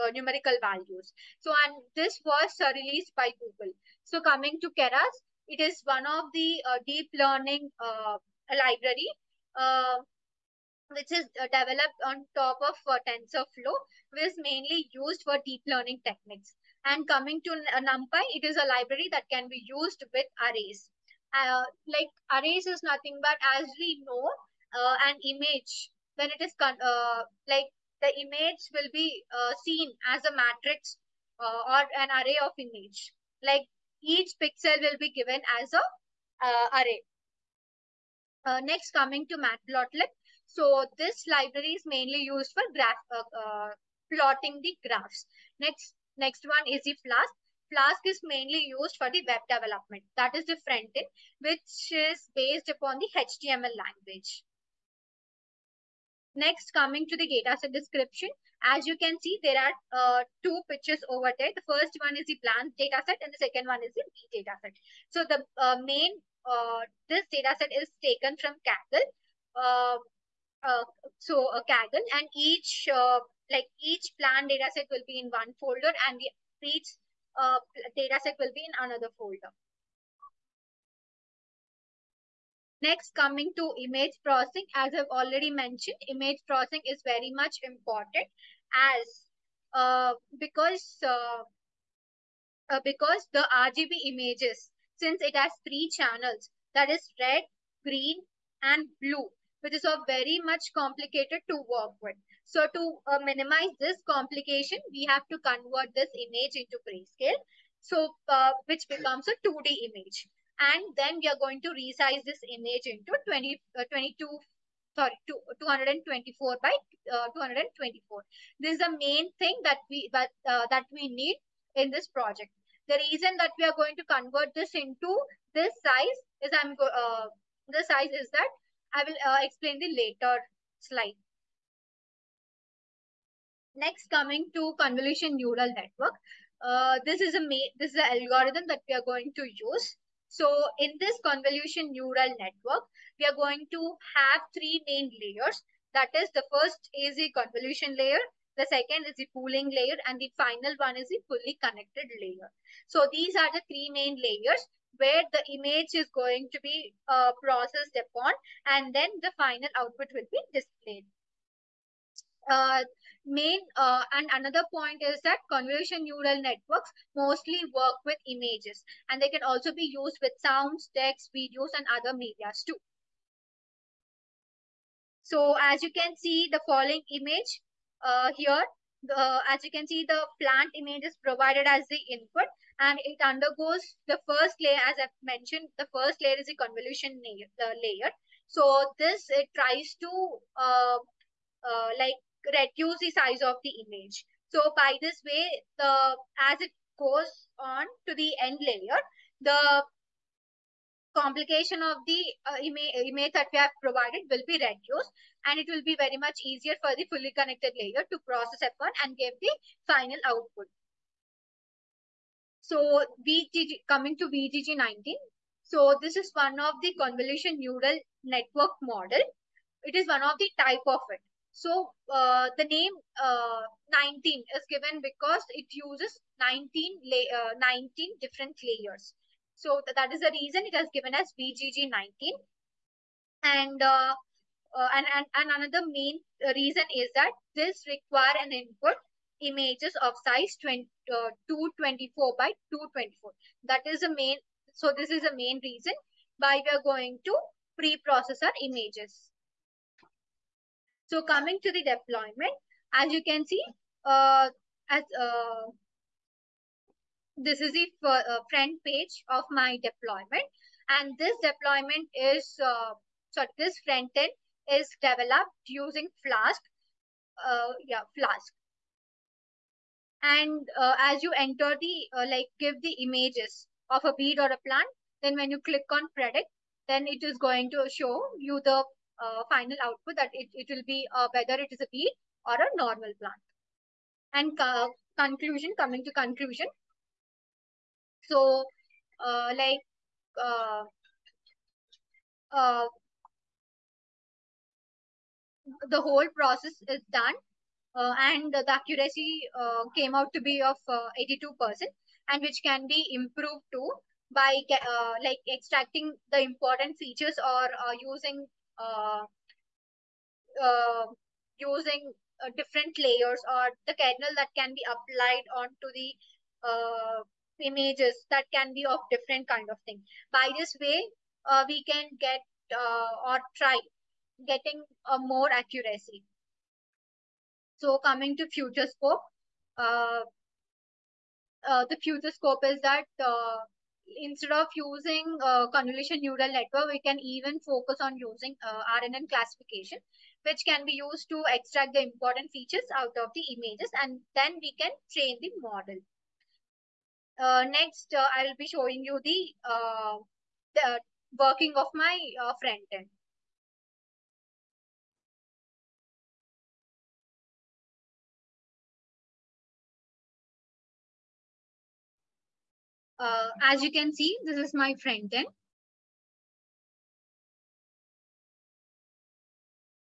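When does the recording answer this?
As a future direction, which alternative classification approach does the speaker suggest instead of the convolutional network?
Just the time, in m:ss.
5:39.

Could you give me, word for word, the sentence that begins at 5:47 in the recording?
Uh, next, I uh, will be showing you the, uh, the working of my uh, front end.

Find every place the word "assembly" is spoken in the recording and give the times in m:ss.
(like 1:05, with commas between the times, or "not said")
not said.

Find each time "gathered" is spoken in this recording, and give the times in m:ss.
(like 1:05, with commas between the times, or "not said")
not said.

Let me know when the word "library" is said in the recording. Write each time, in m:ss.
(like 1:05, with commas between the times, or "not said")
0:08, 0:18, 0:41.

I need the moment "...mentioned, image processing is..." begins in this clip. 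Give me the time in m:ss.
1:25.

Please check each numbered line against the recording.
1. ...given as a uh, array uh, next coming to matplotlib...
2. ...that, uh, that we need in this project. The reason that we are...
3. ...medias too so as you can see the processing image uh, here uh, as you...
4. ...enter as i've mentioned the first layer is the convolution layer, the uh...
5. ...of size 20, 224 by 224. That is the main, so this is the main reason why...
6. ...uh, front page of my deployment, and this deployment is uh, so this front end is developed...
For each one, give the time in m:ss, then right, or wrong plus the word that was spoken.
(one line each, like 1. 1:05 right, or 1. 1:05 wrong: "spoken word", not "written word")
1. 0:35 right
2. 2:00 right
3. 2:52 wrong: "following", not "processing"
4. 3:04 wrong: "layer", not "enter"
5. 4:00 right
6. 4:18 right.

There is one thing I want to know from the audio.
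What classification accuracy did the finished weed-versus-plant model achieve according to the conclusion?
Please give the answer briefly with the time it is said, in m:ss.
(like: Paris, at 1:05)
82%, at 5:00.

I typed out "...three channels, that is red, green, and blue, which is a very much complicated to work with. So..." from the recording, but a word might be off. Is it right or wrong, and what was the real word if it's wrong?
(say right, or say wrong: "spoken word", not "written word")
right.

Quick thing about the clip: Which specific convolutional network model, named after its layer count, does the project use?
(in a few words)
VGG19.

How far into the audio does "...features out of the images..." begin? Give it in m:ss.
5:42.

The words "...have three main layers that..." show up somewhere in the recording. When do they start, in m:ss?
2:24.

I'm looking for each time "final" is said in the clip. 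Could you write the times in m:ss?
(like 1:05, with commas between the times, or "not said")
2:30, 2:39, 3:29, 4:39.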